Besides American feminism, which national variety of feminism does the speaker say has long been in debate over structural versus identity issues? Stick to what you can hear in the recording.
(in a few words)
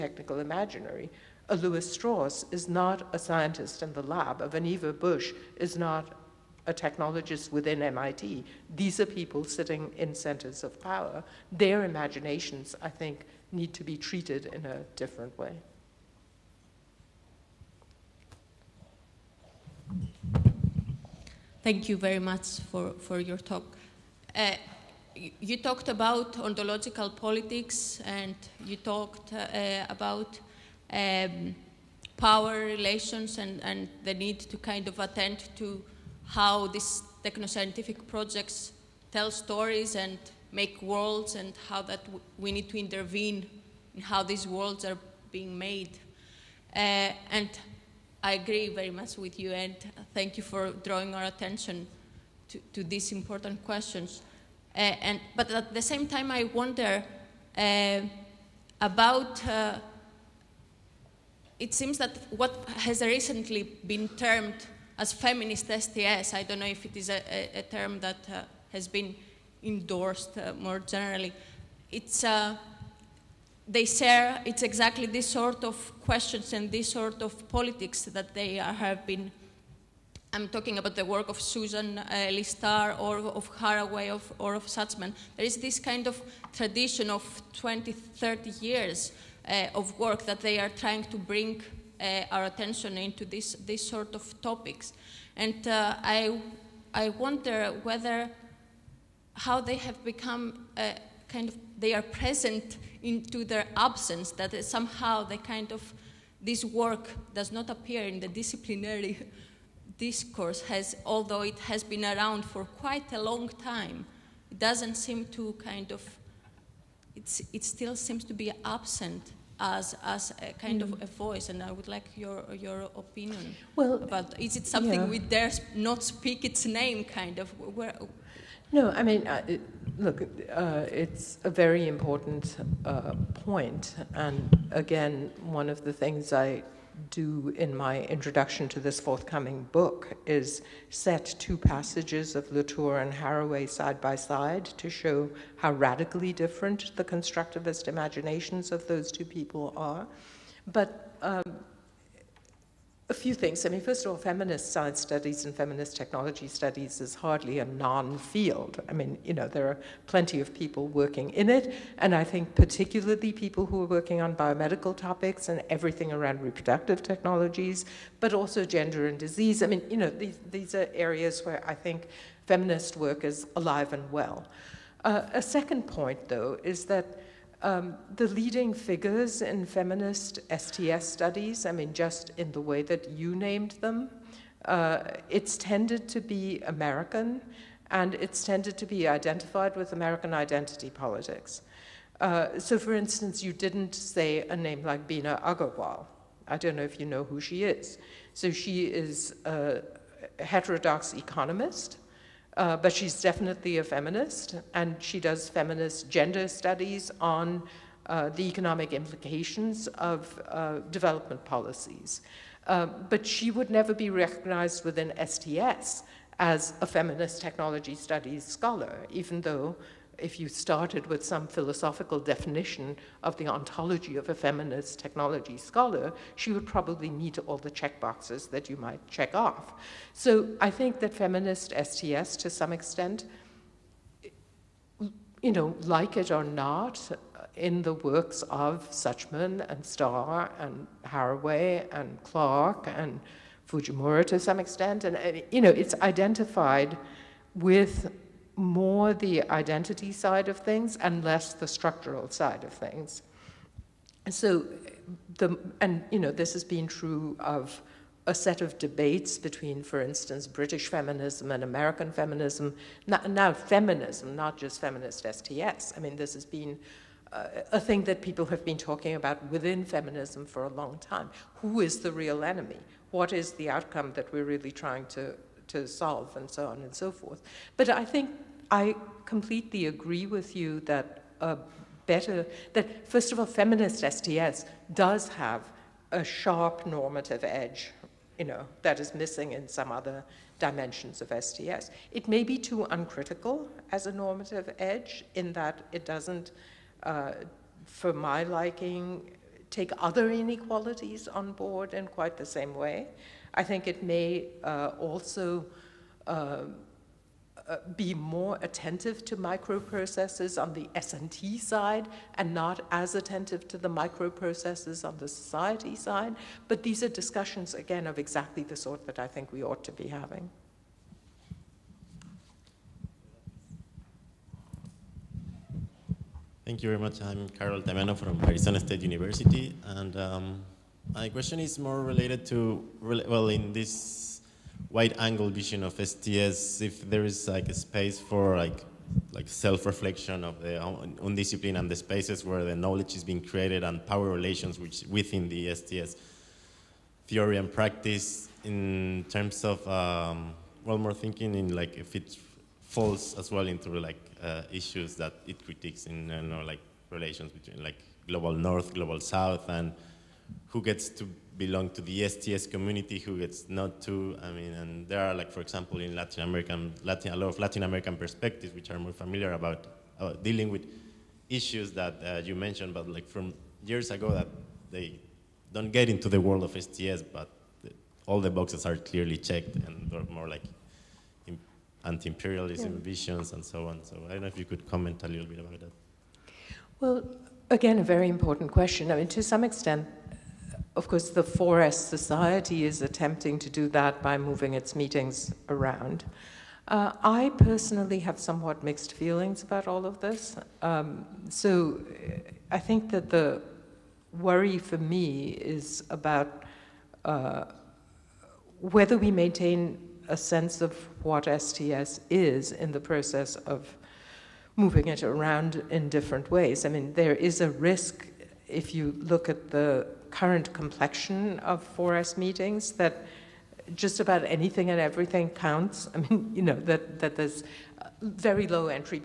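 British feminism.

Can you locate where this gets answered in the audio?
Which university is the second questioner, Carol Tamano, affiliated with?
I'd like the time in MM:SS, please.
05:28.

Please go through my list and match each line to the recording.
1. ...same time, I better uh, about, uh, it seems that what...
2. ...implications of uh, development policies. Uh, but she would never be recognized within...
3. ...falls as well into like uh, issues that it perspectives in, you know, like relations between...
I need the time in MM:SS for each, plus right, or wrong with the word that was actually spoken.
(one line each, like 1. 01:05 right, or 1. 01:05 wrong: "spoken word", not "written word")
1. 00:55 wrong: "wonder", not "better"
2. 03:28 right
3. 05:52 wrong: "critiques", not "perspectives".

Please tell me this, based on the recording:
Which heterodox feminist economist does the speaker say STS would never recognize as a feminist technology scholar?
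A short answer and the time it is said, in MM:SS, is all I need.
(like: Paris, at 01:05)
Bina Agarwal, at 03:15.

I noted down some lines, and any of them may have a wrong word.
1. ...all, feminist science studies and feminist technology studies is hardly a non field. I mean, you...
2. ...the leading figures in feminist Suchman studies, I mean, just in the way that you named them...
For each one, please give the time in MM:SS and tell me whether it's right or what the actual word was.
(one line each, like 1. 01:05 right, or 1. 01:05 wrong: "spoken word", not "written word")
1. 02:34 right
2. 02:58 wrong: "STS", not "Suchman".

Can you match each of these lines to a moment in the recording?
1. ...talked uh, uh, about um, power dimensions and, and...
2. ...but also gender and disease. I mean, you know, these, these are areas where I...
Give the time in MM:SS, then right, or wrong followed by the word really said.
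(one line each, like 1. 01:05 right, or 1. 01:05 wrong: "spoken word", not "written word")
1. 00:28 wrong: "relations", not "dimensions"
2. 02:48 right.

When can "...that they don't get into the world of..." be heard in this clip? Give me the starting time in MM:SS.
06:14.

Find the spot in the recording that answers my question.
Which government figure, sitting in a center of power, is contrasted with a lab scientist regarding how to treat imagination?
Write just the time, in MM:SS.
00:01.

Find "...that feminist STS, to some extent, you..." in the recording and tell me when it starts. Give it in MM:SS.
03:50.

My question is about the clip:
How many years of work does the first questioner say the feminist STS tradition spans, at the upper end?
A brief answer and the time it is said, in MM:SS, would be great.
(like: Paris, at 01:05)
30, at 01:27.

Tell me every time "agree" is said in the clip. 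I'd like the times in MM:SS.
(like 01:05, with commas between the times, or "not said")
00:48, 04:39.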